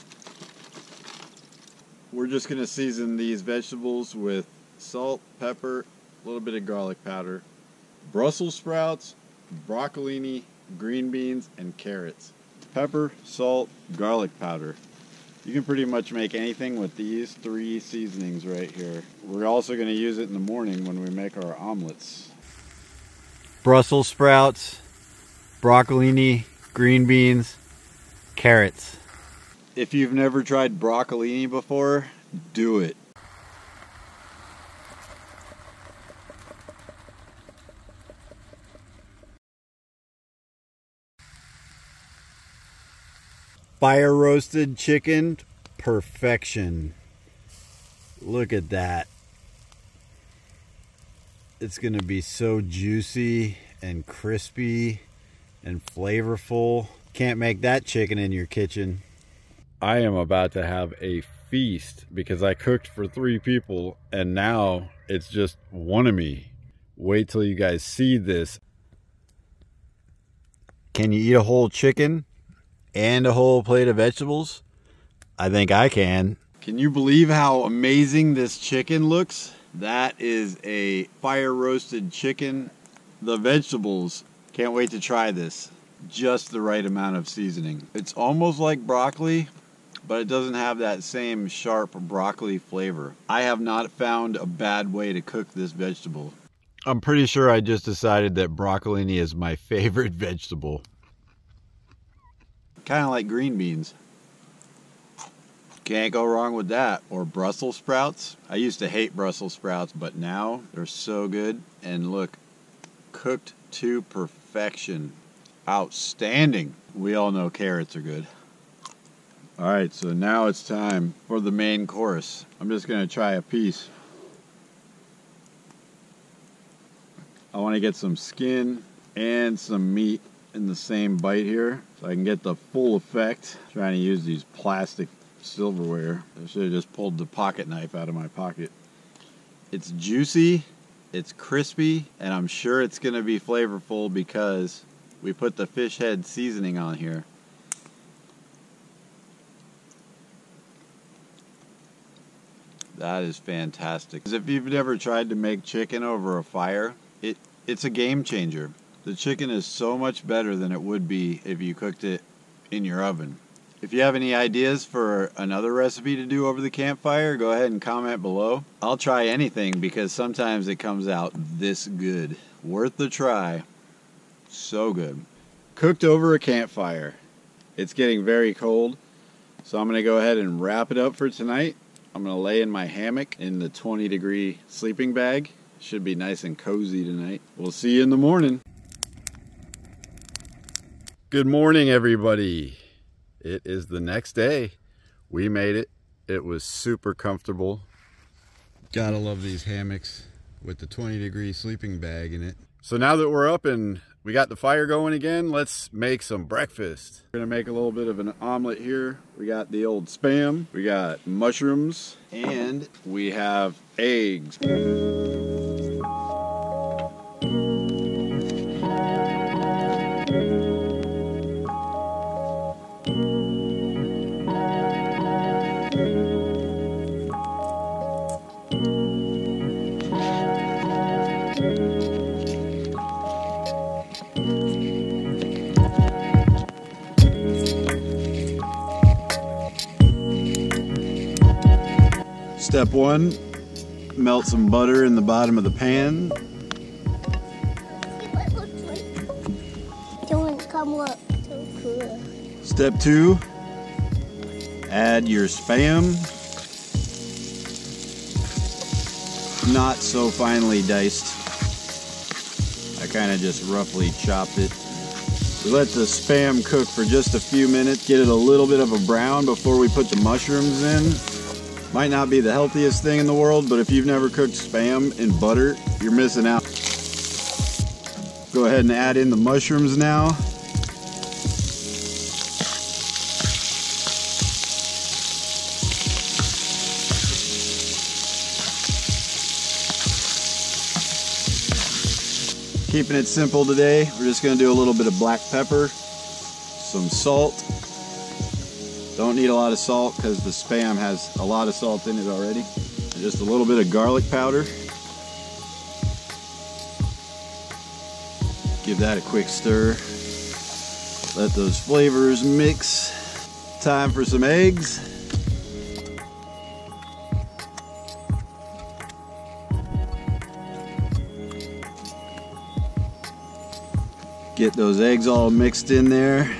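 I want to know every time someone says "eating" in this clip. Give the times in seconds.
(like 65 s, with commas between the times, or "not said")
not said.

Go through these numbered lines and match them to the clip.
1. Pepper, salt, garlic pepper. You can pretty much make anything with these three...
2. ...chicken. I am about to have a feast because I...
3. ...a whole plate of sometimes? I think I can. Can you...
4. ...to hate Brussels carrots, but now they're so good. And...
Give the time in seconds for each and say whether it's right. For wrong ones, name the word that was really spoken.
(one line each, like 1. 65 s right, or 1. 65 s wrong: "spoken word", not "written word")
1. 12 s wrong: "powder", not "pepper"
2. 58 s wrong: "kitchen", not "chicken"
3. 73 s wrong: "vegetables", not "sometimes"
4. 108 s wrong: "sprouts", not "carrots".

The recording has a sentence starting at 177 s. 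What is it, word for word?
It's getting very cold, so I'm going to go ahead and wrap it up for tonight.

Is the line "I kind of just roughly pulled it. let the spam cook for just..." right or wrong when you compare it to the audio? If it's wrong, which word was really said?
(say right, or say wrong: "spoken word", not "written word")
wrong: "chopped", not "pulled".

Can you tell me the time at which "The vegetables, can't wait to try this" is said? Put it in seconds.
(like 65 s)
83 s.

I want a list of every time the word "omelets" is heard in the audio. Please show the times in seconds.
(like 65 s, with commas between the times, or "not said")
21 s, 208 s.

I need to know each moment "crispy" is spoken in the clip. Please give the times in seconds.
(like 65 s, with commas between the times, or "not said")
54 s, 141 s.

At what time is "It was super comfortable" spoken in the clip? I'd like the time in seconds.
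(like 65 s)
196 s.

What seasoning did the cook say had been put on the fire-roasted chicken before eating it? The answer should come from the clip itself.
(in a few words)
fish head seasoning.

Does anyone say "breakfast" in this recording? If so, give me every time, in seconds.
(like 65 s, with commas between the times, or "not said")
206 s.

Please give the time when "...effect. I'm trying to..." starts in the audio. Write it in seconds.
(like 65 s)
132 s.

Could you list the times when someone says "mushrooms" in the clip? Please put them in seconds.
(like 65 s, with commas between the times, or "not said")
211 s, 270 s, 279 s.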